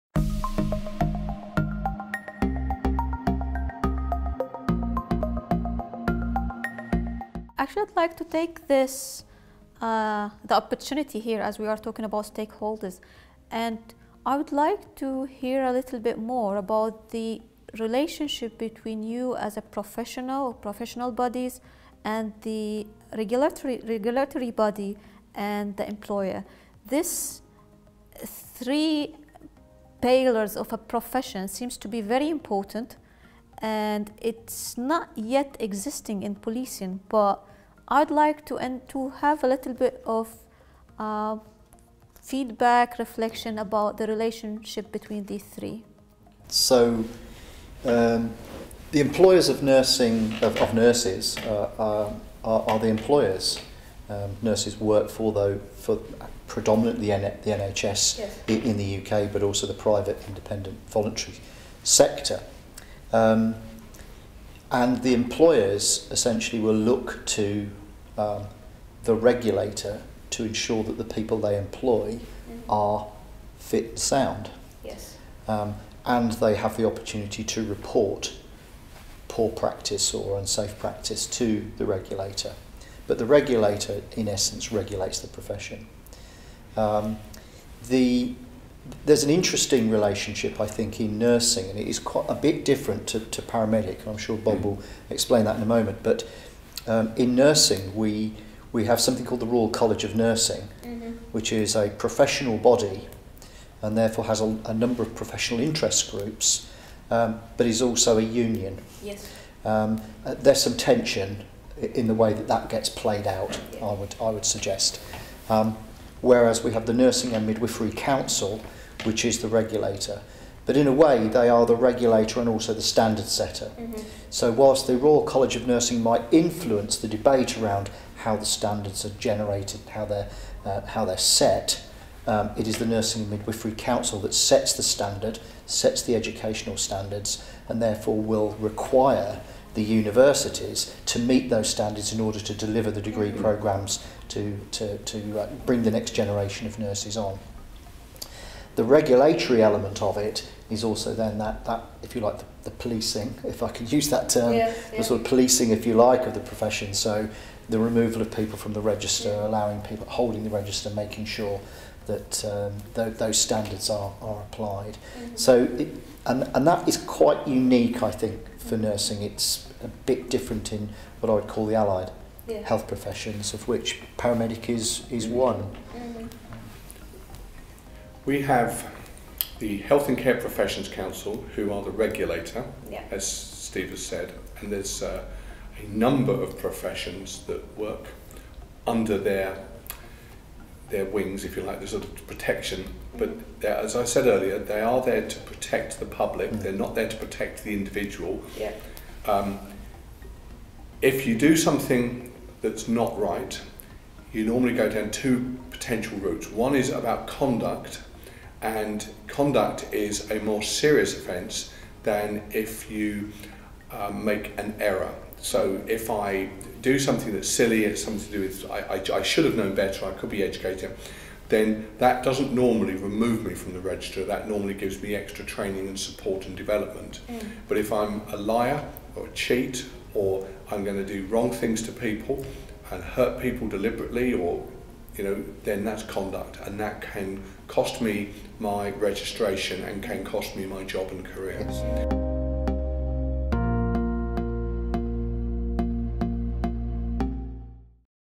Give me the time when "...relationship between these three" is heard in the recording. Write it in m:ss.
0:44.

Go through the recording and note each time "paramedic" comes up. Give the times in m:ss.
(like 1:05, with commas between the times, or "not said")
1:33, 2:54.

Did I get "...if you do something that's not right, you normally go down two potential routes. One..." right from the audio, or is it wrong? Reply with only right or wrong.
right.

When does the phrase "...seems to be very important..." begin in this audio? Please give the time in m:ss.
0:31.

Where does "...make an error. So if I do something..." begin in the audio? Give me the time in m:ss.
3:34.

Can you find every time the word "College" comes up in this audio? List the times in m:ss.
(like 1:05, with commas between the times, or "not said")
1:39, 2:05.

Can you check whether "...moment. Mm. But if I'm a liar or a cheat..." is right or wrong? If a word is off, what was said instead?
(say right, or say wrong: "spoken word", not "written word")
wrong: "development", not "moment".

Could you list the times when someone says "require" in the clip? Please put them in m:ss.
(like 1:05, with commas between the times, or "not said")
2:18.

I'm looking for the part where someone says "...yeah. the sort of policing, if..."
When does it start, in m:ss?
2:34.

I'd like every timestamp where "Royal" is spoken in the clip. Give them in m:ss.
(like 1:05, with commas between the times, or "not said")
1:39, 2:04.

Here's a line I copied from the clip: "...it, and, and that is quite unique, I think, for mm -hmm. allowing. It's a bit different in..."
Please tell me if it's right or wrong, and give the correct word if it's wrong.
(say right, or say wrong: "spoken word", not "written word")
wrong: "nursing", not "allowing".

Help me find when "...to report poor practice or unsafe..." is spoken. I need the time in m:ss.
1:17.